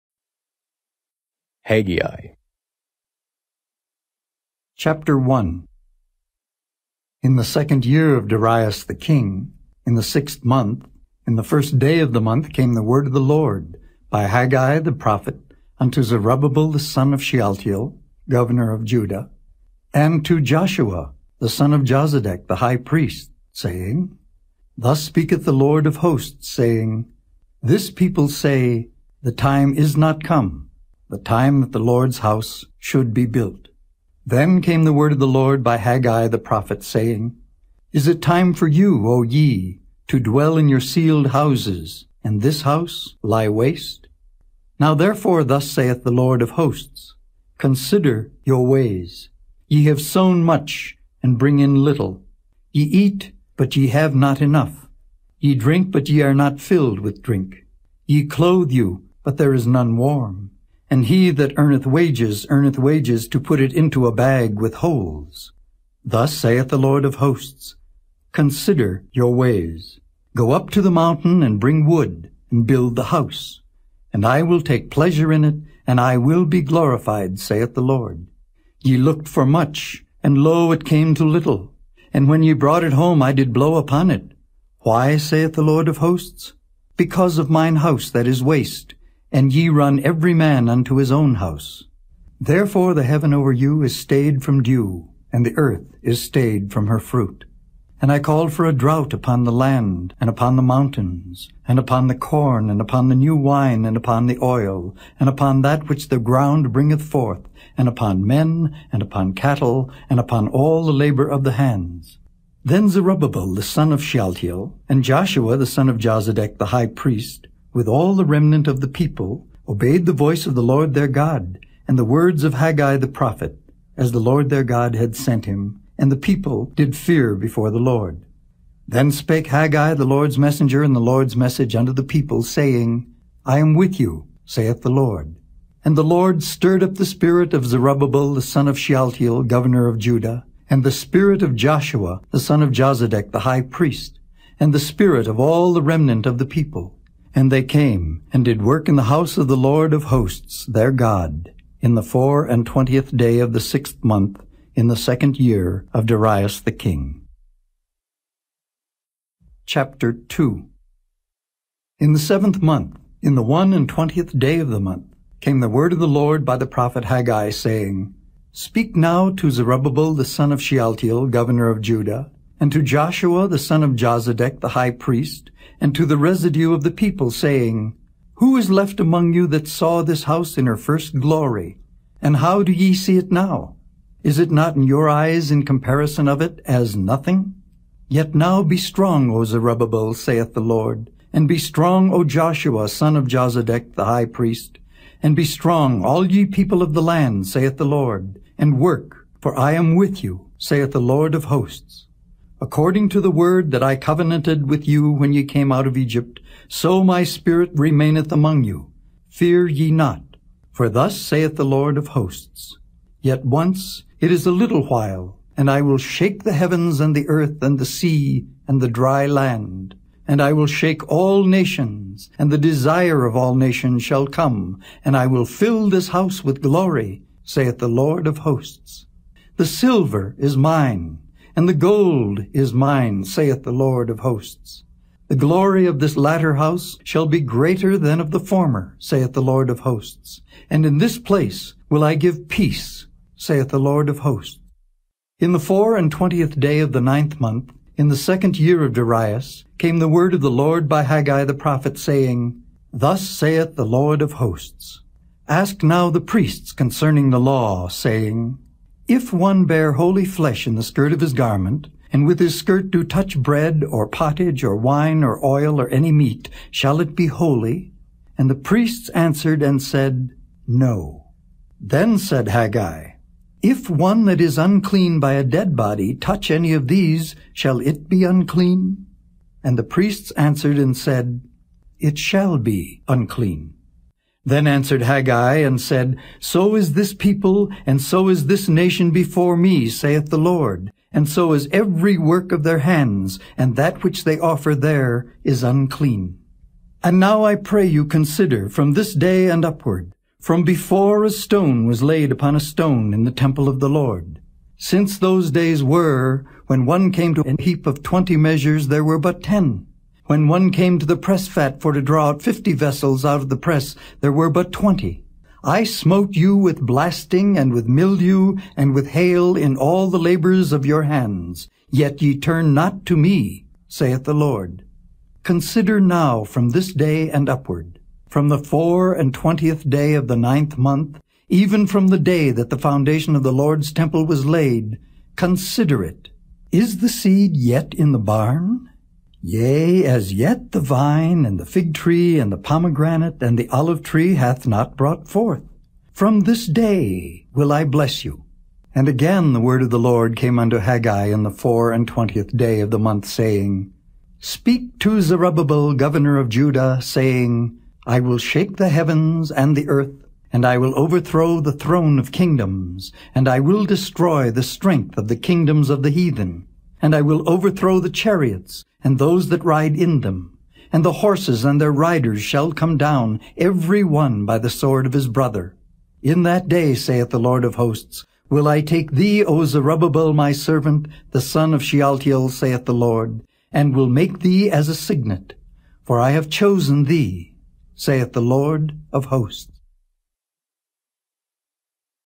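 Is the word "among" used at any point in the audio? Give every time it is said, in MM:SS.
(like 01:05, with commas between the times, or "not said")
02:58, 03:28.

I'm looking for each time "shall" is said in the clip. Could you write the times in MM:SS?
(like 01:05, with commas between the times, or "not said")
03:44, 03:57, 04:26, 04:37, 04:42, 06:12.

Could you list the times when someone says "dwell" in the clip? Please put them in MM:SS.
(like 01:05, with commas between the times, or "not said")
00:40.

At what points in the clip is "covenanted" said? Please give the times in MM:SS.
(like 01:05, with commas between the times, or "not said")
03:23.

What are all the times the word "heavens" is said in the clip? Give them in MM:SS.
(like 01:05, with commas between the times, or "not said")
01:33, 03:36, 05:58.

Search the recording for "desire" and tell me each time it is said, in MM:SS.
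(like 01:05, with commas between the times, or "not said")
03:42.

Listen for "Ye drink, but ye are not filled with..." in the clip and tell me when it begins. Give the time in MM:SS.
00:55.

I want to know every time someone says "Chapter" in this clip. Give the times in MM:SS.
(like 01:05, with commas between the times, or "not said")
00:04, 02:39.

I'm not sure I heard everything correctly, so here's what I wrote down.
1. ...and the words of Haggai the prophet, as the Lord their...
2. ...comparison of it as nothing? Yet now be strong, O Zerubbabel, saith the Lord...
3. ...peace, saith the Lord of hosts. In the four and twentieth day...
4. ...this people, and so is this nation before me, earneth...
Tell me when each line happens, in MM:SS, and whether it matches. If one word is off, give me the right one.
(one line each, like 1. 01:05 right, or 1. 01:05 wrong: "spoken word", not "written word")
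1. 02:01 right
2. 03:05 right
3. 04:02 right
4. 04:46 wrong: "saith", not "earneth".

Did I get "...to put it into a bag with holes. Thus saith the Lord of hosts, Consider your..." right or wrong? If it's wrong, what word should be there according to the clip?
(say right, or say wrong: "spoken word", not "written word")
right.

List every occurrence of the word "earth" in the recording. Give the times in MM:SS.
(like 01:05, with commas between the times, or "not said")
01:35, 03:37, 05:59.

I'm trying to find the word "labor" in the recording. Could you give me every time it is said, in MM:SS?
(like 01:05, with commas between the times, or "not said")
01:50, 05:20.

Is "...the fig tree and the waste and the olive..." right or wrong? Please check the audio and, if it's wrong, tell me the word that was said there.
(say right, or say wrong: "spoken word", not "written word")
wrong: "pomegranate", not "waste".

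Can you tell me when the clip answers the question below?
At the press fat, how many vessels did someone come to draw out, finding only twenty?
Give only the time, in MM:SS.
05:12.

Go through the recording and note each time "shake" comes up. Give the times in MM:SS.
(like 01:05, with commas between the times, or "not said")
03:35, 03:40, 05:58.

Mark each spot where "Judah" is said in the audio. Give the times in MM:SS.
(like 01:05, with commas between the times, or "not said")
00:18, 02:19, 02:51, 05:56.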